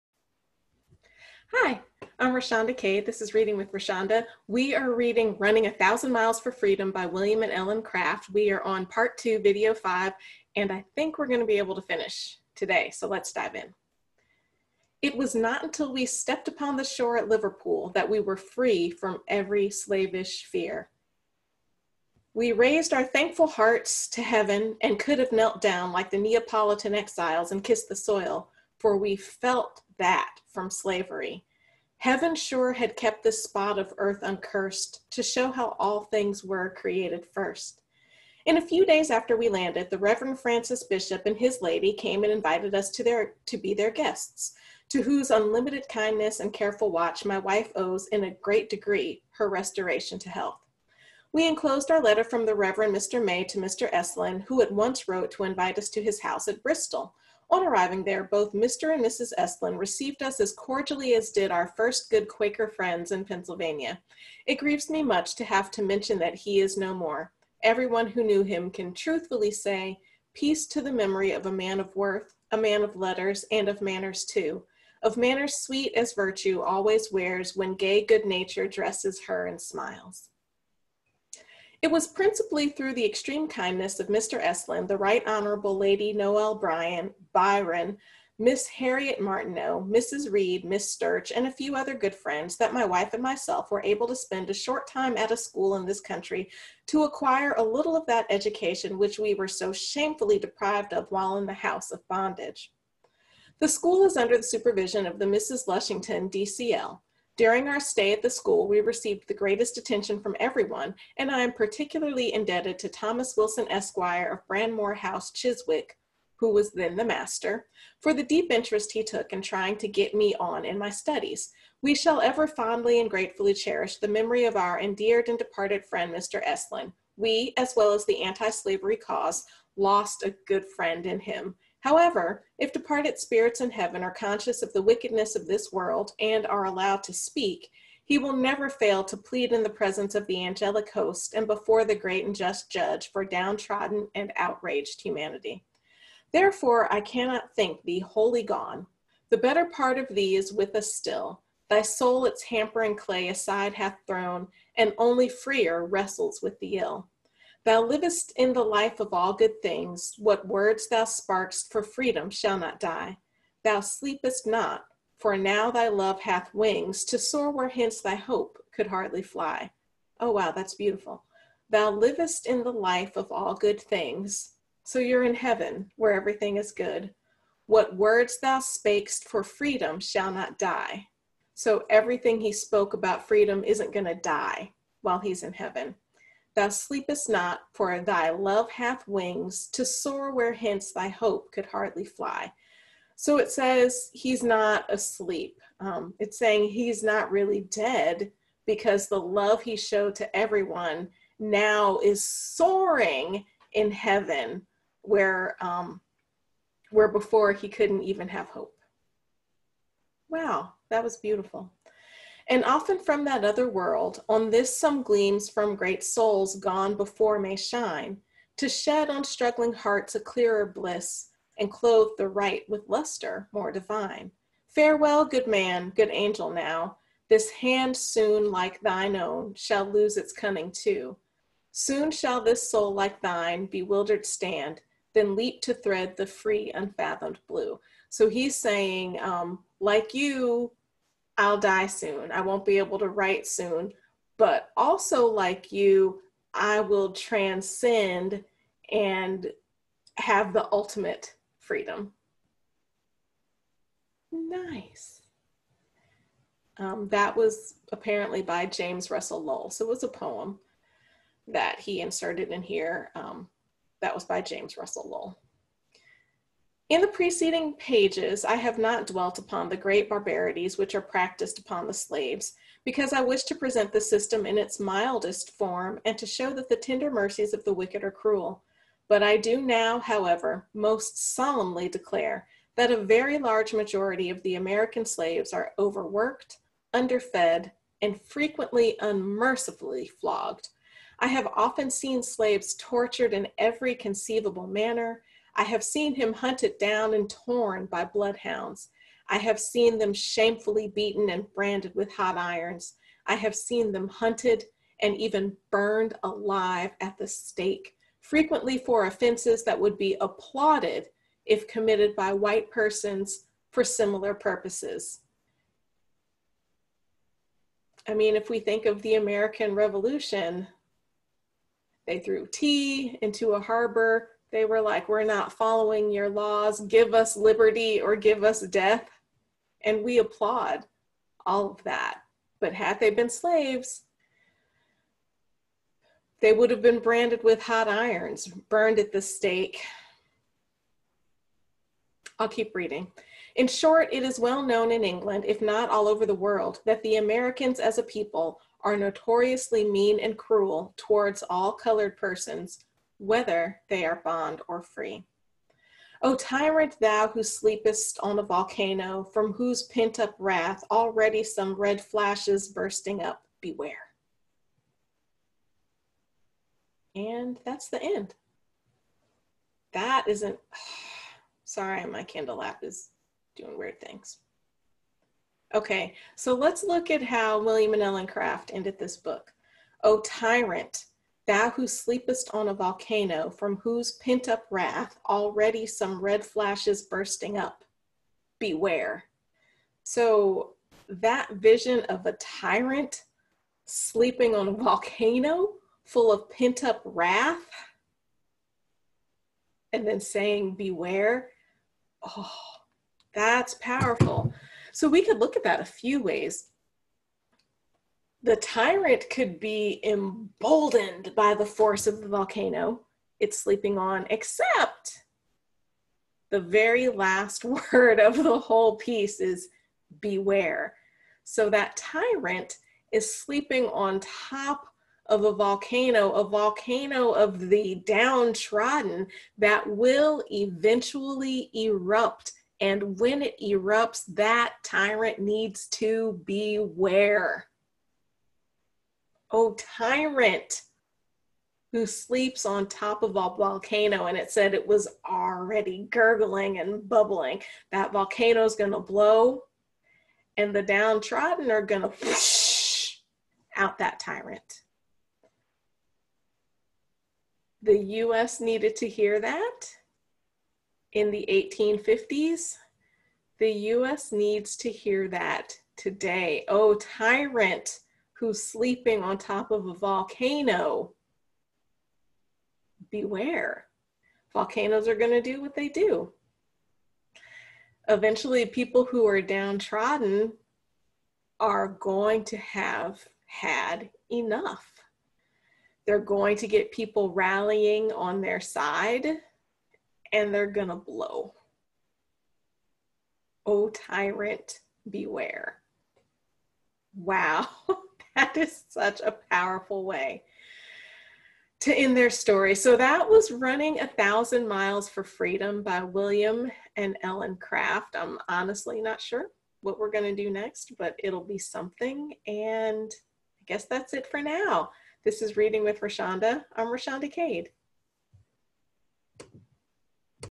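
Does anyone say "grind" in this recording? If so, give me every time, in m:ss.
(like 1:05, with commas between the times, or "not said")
not said.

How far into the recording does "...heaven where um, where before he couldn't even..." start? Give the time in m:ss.
3:23.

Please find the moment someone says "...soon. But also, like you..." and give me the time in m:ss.
4:03.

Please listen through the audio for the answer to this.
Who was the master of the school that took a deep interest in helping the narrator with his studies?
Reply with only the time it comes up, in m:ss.
1:52.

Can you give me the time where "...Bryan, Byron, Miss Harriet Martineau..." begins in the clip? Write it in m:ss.
1:26.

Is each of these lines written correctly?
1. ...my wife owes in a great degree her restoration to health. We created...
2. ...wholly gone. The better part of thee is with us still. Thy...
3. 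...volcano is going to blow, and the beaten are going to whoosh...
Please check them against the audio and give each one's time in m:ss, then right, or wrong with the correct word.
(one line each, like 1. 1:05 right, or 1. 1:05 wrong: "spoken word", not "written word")
1. 0:47 wrong: "enclosed", not "created"
2. 2:27 right
3. 7:28 wrong: "downtrodden", not "beaten".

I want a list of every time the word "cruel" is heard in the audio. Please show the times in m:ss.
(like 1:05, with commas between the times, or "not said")
4:38, 5:50.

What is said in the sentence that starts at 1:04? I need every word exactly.
It grieves me much to have to mention that he is no more.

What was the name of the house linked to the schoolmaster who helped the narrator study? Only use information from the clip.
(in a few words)
Bradmore House.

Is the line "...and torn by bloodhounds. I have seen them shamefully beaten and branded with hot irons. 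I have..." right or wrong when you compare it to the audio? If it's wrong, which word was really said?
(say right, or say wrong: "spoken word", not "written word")
right.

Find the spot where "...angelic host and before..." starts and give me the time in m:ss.
2:20.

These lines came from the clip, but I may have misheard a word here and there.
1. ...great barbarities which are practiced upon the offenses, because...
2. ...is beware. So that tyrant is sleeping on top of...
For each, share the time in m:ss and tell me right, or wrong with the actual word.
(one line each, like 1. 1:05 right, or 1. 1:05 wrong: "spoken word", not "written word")
1. 4:29 wrong: "slaves", not "offenses"
2. 6:59 right.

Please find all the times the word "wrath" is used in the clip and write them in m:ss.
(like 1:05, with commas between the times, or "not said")
6:00, 6:24, 6:37.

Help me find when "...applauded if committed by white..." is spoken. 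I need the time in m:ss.
5:10.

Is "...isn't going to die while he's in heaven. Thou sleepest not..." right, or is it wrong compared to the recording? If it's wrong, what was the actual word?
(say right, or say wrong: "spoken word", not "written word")
right.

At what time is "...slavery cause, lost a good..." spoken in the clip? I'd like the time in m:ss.
2:08.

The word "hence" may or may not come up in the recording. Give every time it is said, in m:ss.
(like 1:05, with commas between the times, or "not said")
2:47, 3:10.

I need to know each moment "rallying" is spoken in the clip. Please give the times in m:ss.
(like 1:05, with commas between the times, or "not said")
8:07.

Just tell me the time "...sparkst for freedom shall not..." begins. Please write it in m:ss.
2:41.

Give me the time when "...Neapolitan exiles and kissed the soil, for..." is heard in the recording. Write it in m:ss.
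0:26.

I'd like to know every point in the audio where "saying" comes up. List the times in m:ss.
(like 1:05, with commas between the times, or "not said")
3:16, 3:58, 6:40.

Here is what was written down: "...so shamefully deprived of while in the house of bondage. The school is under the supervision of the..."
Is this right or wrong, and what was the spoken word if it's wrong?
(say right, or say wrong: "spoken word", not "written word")
right.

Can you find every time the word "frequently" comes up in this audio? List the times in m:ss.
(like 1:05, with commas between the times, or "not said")
4:48, 5:08.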